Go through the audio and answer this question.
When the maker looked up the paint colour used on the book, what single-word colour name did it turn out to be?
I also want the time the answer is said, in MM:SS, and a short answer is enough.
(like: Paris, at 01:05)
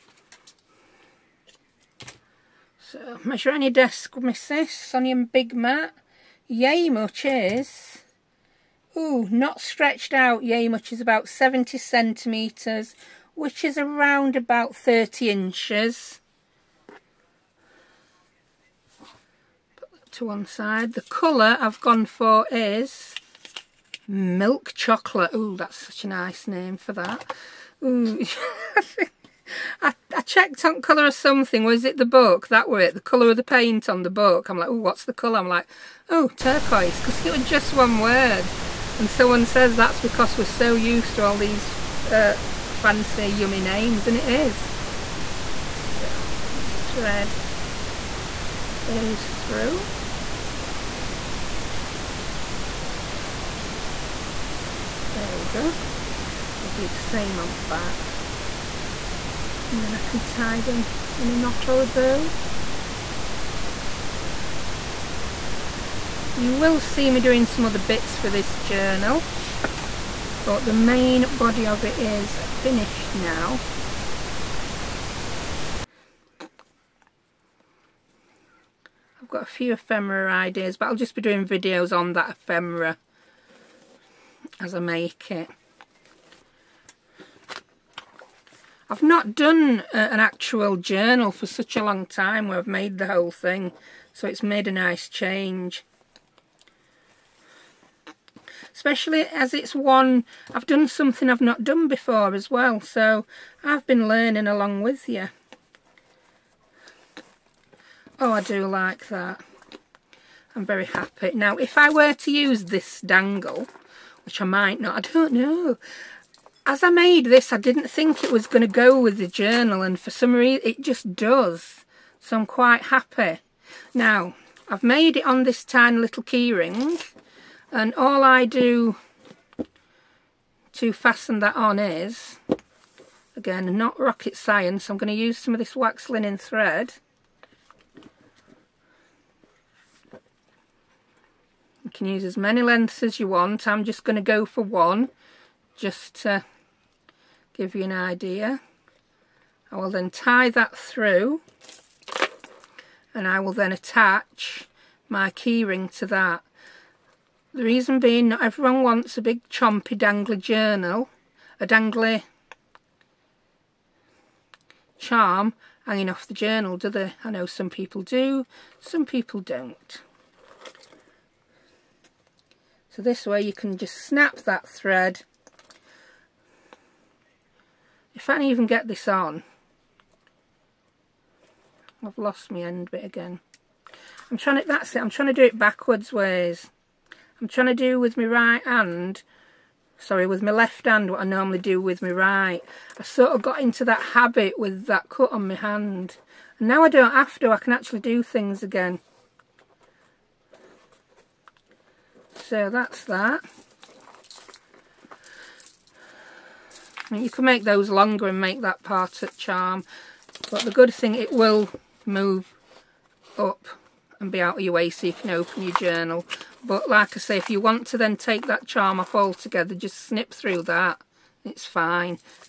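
Turquoise, at 00:36.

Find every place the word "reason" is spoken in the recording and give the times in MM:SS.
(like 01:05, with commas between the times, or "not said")
02:00, 02:37.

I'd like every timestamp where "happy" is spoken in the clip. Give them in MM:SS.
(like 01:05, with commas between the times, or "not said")
01:50, 02:02.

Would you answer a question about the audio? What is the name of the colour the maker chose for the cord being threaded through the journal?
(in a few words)
Milk chocolate.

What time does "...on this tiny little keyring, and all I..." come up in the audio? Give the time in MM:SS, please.
02:05.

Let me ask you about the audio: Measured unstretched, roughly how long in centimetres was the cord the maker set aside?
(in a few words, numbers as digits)
70 centimetres.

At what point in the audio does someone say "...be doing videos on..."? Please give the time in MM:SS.
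01:21.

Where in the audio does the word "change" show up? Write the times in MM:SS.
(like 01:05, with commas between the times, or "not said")
01:35.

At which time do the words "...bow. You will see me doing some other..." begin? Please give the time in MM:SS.
01:01.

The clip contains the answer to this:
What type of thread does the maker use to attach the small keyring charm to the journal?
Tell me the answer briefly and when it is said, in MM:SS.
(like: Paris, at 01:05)
Wax linen thread, at 02:15.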